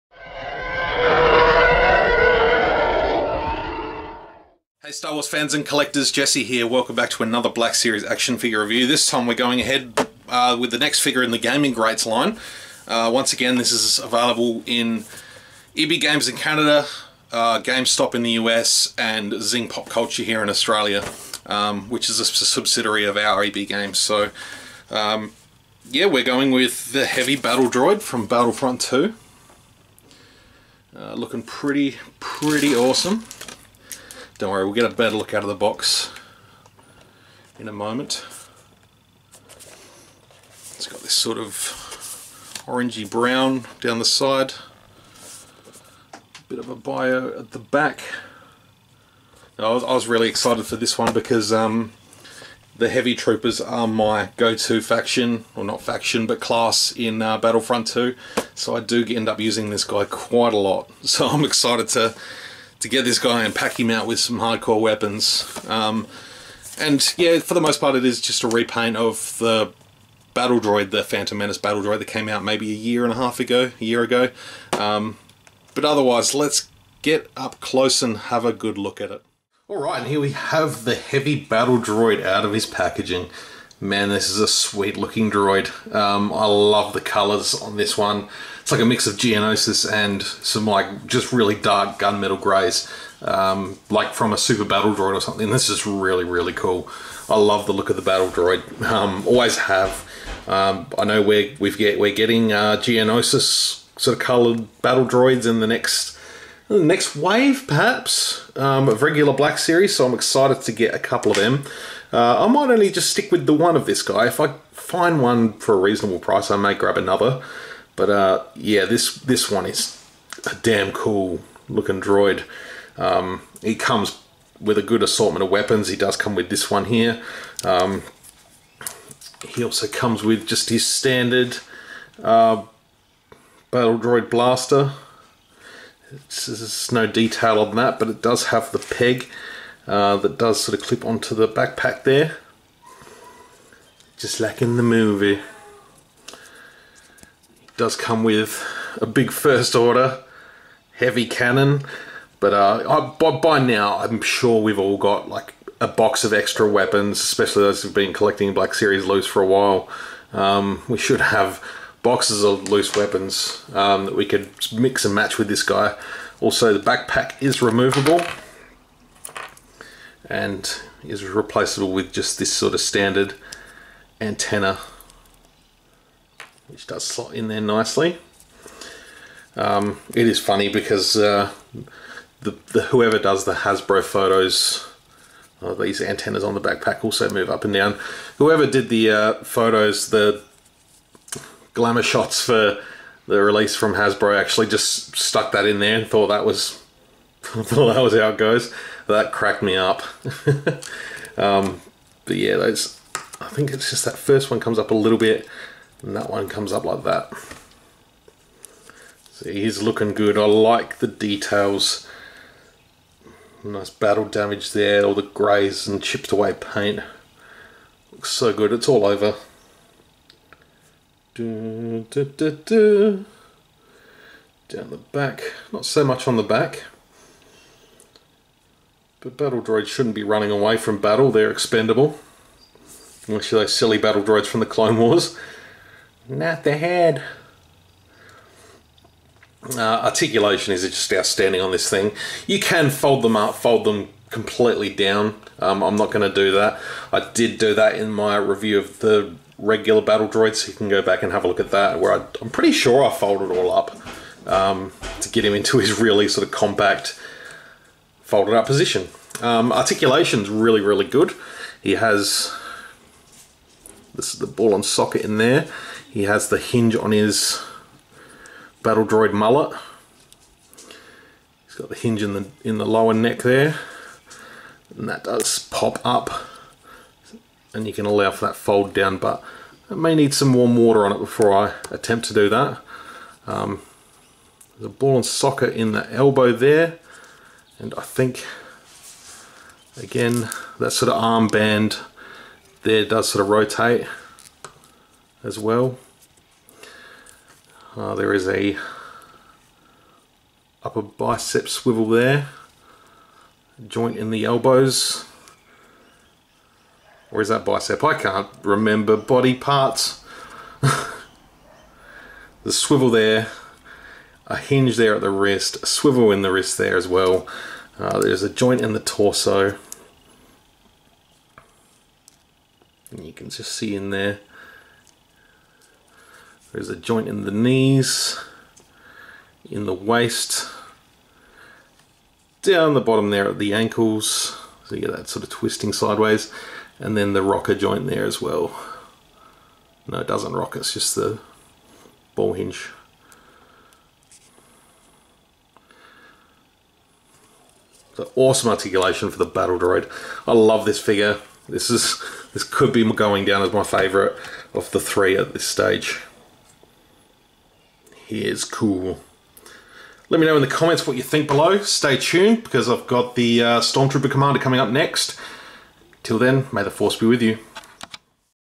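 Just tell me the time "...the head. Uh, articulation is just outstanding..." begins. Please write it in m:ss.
3:56.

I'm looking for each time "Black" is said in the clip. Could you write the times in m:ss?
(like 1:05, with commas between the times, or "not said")
0:07, 1:49, 2:38.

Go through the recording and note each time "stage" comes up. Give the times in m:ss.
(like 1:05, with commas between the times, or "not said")
5:55.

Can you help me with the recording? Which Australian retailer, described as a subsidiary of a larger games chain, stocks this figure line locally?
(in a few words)
Zing Pop Culture.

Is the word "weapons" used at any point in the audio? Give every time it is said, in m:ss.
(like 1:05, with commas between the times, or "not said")
1:04, 2:05, 2:36, 2:42.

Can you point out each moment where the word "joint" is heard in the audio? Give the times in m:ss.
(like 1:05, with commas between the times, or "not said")
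5:03, 5:18, 5:26, 5:37.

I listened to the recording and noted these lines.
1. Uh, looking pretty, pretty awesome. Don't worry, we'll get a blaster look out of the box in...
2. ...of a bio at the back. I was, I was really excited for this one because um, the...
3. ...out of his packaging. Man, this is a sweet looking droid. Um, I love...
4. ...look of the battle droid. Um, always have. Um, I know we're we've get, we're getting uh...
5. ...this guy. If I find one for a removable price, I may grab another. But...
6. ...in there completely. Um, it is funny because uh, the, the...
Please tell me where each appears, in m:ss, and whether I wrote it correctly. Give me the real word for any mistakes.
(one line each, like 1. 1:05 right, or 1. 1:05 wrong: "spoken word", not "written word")
1. 0:30 wrong: "better", not "blaster"
2. 0:46 right
3. 1:22 right
4. 1:37 right
5. 1:53 wrong: "reasonable", not "removable"
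6. 2:57 wrong: "nicely", not "completely".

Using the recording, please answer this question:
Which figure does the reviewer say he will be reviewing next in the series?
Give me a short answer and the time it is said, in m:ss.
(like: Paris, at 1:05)
Stormtrooper Commander, at 6:03.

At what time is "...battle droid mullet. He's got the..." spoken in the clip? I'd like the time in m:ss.
4:28.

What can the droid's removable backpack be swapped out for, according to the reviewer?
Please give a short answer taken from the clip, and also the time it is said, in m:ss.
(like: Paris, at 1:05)
standard antenna, at 2:52.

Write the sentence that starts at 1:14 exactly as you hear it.
Um, but otherwise, let's get up close and have a good look at it.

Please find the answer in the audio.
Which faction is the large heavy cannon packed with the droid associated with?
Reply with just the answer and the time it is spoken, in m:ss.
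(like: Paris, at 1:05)
First Order, at 2:29.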